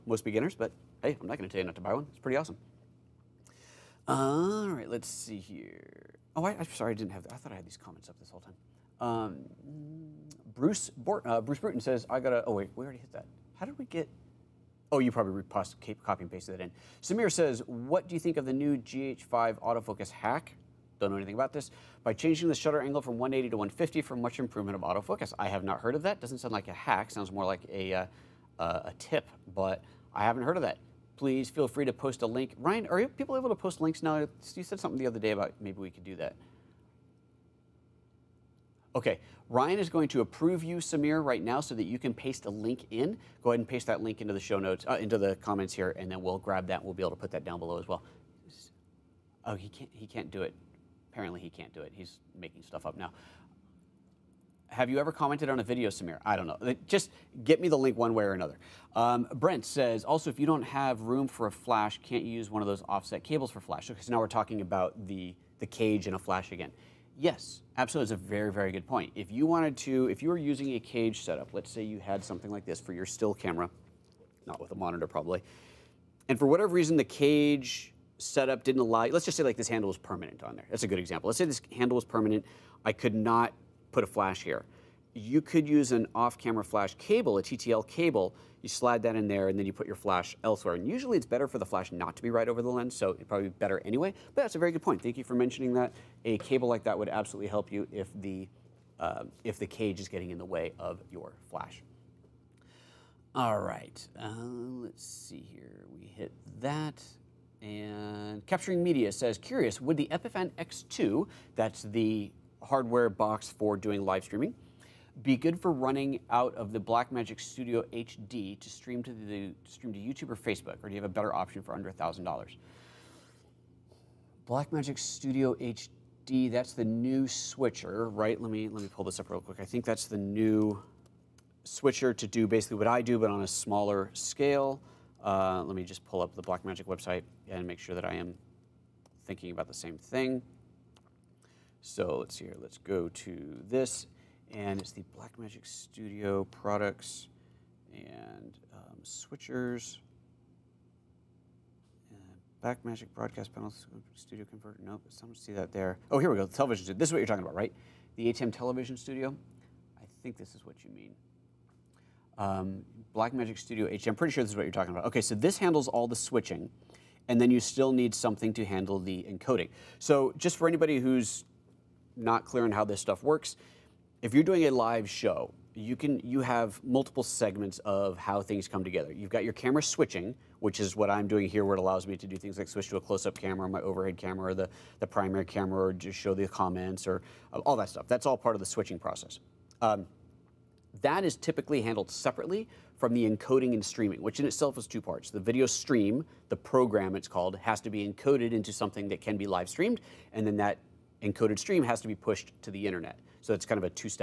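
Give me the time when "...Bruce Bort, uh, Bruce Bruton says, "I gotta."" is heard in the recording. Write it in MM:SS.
00:10.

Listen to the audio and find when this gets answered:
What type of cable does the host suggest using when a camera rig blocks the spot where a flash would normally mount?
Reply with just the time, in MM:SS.
01:27.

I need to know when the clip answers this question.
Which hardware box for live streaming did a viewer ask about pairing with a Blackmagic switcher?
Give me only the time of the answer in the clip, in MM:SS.
01:50.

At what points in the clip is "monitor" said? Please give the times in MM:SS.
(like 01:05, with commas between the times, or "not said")
01:14.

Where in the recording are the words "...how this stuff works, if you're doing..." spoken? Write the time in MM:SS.
02:52.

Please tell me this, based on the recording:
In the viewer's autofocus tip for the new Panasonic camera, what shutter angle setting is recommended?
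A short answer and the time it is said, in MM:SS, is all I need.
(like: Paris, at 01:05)
150, at 00:23.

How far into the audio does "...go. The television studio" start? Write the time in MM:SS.
02:36.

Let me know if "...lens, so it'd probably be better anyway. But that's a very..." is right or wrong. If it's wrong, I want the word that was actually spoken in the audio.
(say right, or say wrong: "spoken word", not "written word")
right.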